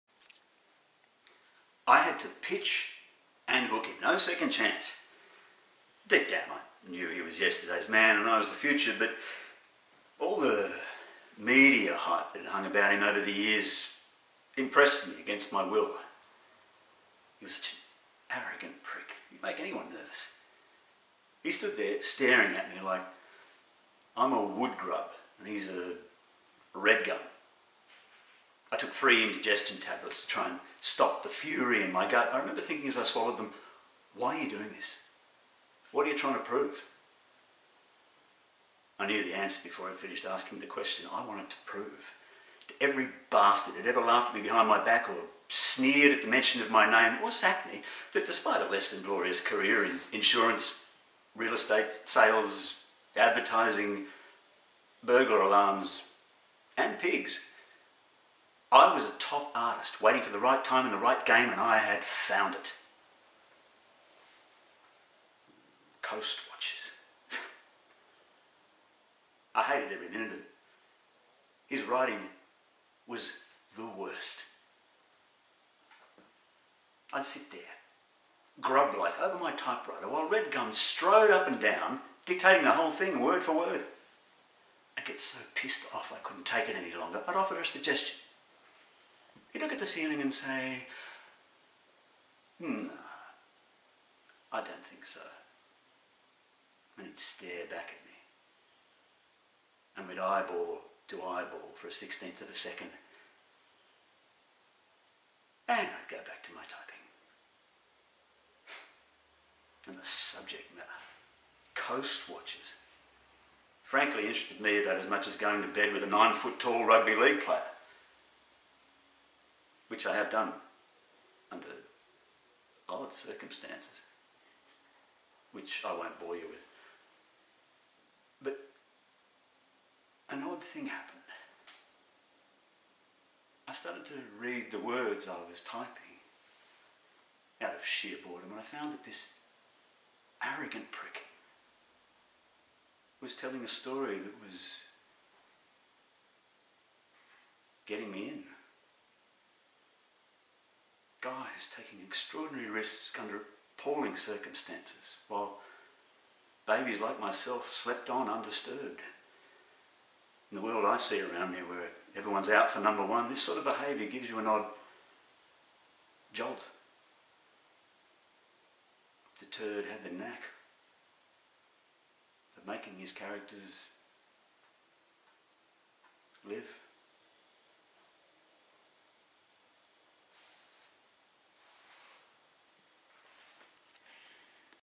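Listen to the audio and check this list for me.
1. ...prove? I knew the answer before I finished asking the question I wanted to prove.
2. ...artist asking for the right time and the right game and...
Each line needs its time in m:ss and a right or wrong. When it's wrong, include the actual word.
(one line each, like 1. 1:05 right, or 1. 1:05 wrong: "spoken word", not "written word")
1. 0:36 right
2. 0:59 wrong: "waiting", not "asking".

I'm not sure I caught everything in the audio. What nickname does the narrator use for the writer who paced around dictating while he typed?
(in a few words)
Redgum.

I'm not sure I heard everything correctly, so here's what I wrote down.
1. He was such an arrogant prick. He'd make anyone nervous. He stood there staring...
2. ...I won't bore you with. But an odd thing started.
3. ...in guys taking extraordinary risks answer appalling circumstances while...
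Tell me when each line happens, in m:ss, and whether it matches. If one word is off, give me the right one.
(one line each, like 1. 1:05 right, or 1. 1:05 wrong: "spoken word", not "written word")
1. 0:17 right
2. 2:05 wrong: "happened", not "started"
3. 2:28 wrong: "under", not "answer".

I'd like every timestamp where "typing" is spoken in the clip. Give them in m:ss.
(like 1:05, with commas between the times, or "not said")
1:46, 2:15.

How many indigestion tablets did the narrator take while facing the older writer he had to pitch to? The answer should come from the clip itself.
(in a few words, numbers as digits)
3.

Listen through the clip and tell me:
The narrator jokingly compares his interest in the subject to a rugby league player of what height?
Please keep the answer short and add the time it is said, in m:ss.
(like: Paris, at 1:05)
9 foot, at 1:56.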